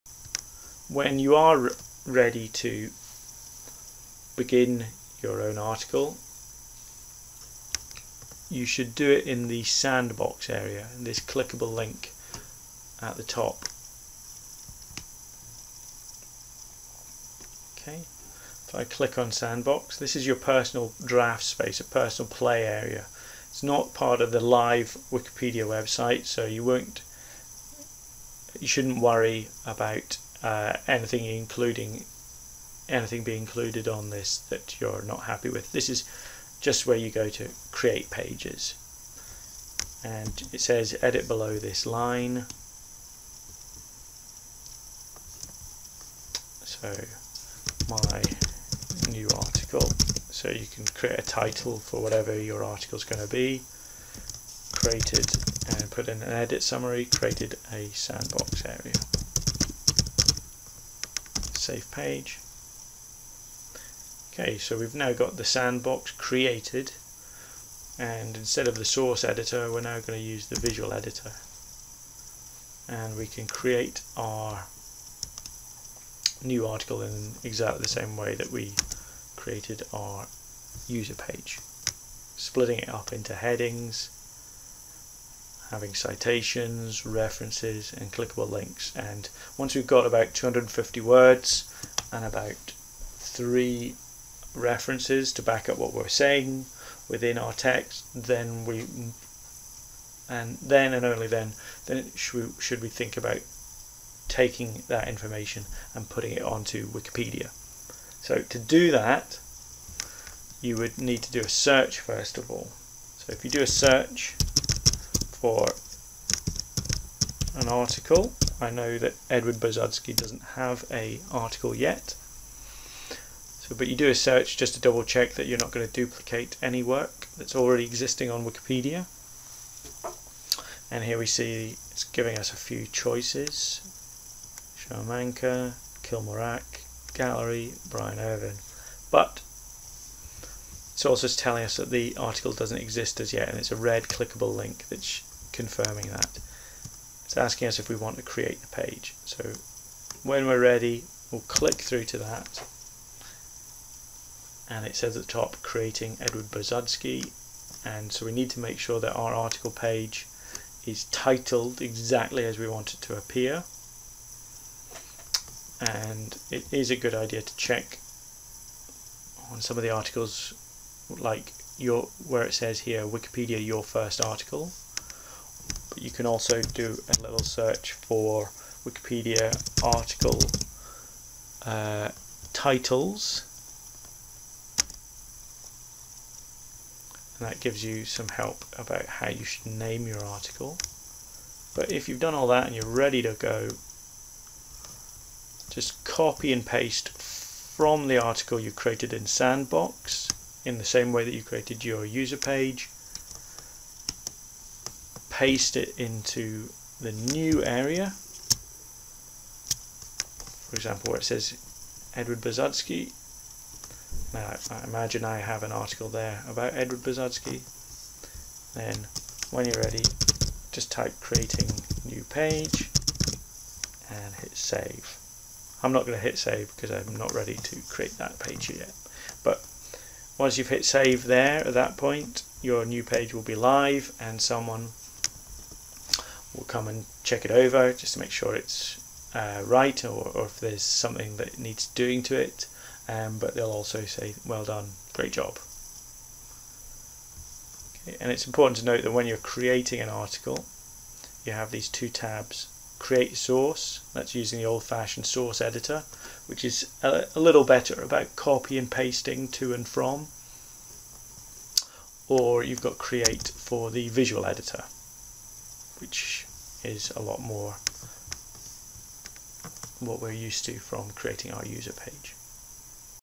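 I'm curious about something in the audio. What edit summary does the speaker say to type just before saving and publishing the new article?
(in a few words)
creating new page.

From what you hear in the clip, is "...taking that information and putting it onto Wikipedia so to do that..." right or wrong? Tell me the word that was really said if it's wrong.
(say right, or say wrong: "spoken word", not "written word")
right.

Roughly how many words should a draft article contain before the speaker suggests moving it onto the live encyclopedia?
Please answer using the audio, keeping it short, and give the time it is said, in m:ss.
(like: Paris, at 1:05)
250, at 1:30.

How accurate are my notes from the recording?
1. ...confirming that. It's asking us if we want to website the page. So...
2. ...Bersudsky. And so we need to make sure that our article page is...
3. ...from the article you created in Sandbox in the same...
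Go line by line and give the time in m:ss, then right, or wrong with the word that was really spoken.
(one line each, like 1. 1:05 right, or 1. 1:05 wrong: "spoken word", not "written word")
1. 2:25 wrong: "create", not "website"
2. 2:36 right
3. 3:17 right.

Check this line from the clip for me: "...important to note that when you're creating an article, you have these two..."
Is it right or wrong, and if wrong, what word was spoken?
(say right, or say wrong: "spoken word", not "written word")
right.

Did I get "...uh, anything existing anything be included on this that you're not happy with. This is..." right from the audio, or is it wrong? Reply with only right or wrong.
wrong.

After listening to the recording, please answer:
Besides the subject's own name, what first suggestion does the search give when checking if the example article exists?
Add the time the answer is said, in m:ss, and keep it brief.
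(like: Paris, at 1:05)
Sharmanka, at 2:14.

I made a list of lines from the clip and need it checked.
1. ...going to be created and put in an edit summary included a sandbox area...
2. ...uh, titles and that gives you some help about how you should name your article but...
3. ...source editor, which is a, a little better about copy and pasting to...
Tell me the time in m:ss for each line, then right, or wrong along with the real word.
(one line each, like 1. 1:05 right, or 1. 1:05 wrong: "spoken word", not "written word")
1. 0:53 wrong: "created", not "included"
2. 3:01 right
3. 4:15 right.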